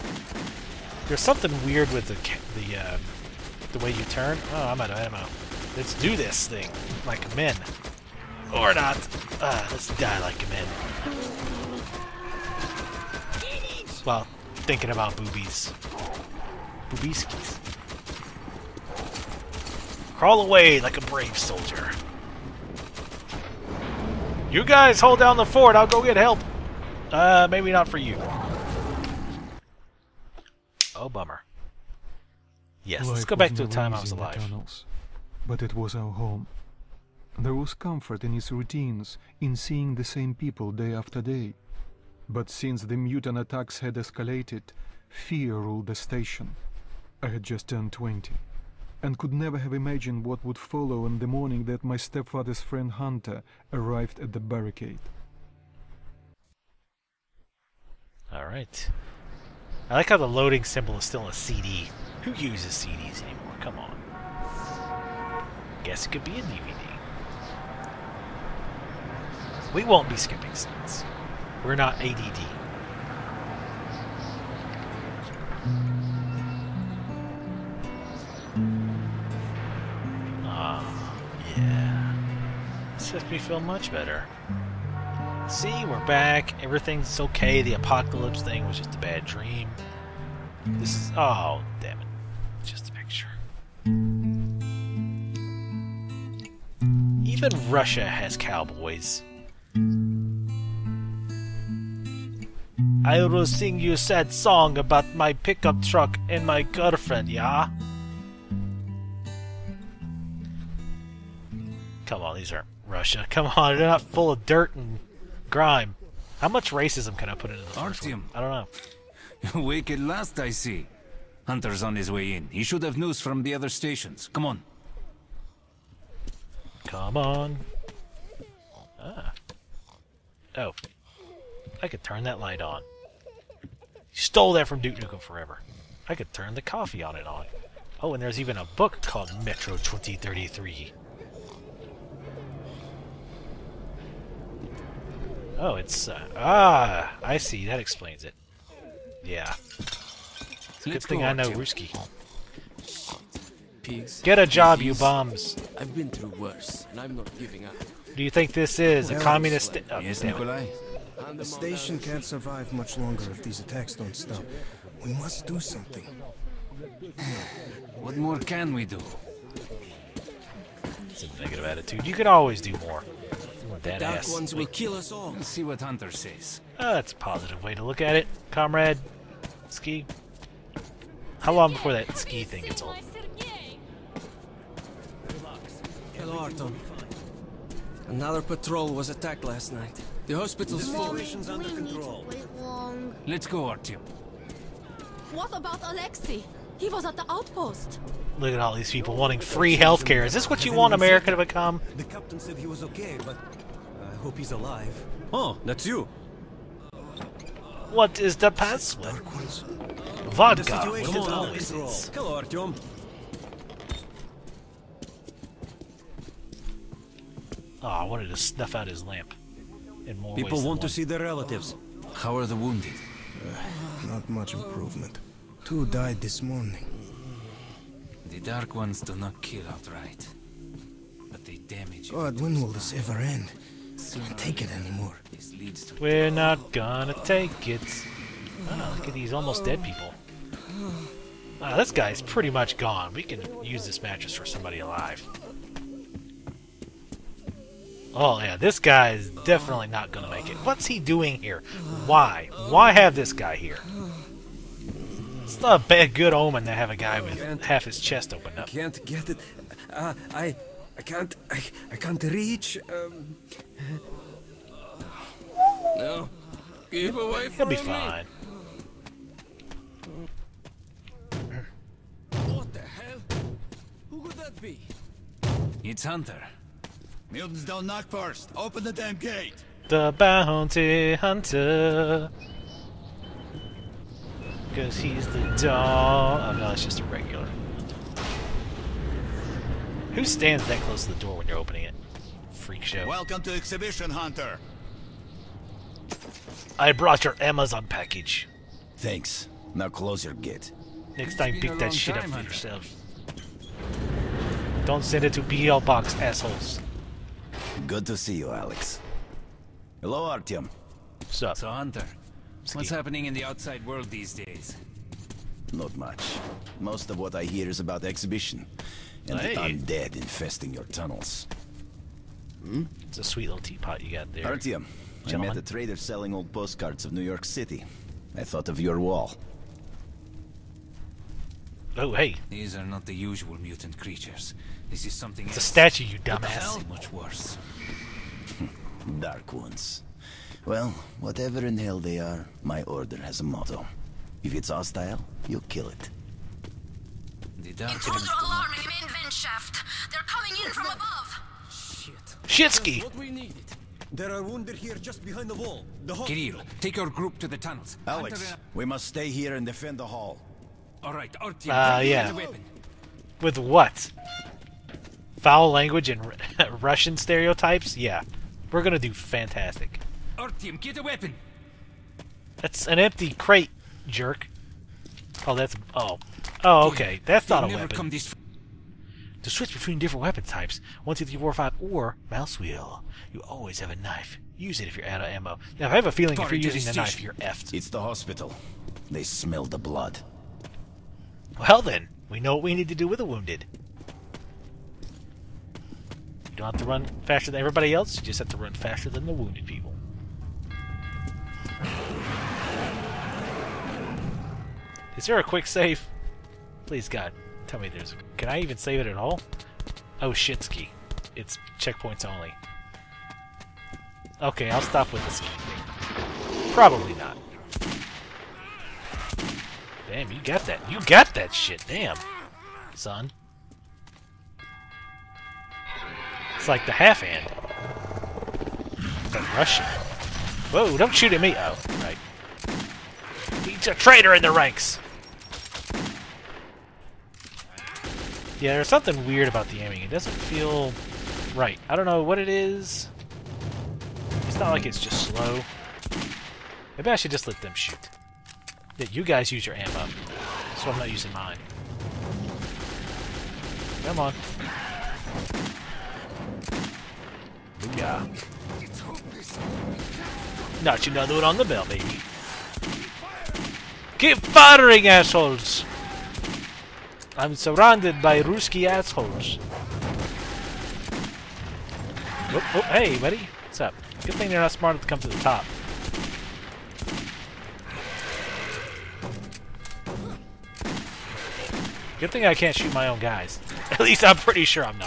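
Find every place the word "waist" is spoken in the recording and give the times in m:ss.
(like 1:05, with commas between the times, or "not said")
not said.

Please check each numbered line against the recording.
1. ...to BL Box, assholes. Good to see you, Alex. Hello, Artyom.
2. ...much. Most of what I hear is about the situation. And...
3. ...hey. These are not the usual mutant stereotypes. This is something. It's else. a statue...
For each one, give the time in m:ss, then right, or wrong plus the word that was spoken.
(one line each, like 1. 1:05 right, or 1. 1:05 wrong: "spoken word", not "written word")
1. 5:05 right
2. 5:15 wrong: "exhibition", not "situation"
3. 5:32 wrong: "creatures", not "stereotypes".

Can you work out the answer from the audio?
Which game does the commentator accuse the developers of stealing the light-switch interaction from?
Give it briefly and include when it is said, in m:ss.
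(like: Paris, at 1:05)
Duke Nukem Forever, at 2:14.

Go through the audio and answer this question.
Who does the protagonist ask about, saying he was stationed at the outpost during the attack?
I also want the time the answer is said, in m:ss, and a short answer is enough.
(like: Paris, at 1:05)
Alexei, at 3:15.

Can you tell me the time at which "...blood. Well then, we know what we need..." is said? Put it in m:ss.
6:29.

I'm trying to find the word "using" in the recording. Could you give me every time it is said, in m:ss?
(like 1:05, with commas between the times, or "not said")
6:26, 7:31.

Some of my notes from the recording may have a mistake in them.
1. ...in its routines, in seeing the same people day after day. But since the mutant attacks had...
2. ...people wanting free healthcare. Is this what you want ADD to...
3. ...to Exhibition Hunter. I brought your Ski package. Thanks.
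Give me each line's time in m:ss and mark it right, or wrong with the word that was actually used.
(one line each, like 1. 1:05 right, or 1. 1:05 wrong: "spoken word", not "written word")
1. 0:38 right
2. 3:18 wrong: "America", not "ADD"
3. 4:53 wrong: "Amazon", not "Ski".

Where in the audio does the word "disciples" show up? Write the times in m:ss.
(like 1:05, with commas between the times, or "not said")
not said.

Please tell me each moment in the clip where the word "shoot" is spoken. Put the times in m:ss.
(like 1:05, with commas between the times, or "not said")
7:11, 7:27, 8:02.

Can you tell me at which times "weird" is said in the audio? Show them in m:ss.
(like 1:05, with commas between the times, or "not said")
0:01, 7:19.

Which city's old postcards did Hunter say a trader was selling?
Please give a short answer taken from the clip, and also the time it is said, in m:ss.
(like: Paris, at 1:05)
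New York City, at 5:27.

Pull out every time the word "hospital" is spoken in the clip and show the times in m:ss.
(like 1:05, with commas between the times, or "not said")
3:10, 6:28.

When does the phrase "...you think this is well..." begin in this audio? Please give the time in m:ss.
2:38.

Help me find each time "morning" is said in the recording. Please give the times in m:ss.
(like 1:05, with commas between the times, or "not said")
0:51, 3:46.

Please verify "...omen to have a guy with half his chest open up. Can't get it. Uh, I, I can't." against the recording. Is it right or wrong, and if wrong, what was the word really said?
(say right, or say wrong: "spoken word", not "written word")
right.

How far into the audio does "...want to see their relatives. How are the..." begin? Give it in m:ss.
3:40.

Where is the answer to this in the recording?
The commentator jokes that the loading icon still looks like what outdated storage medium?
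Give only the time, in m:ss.
1:01.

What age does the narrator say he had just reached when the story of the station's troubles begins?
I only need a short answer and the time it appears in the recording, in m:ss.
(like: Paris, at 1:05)
20, at 0:47.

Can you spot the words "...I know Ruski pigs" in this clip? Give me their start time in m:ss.
2:31.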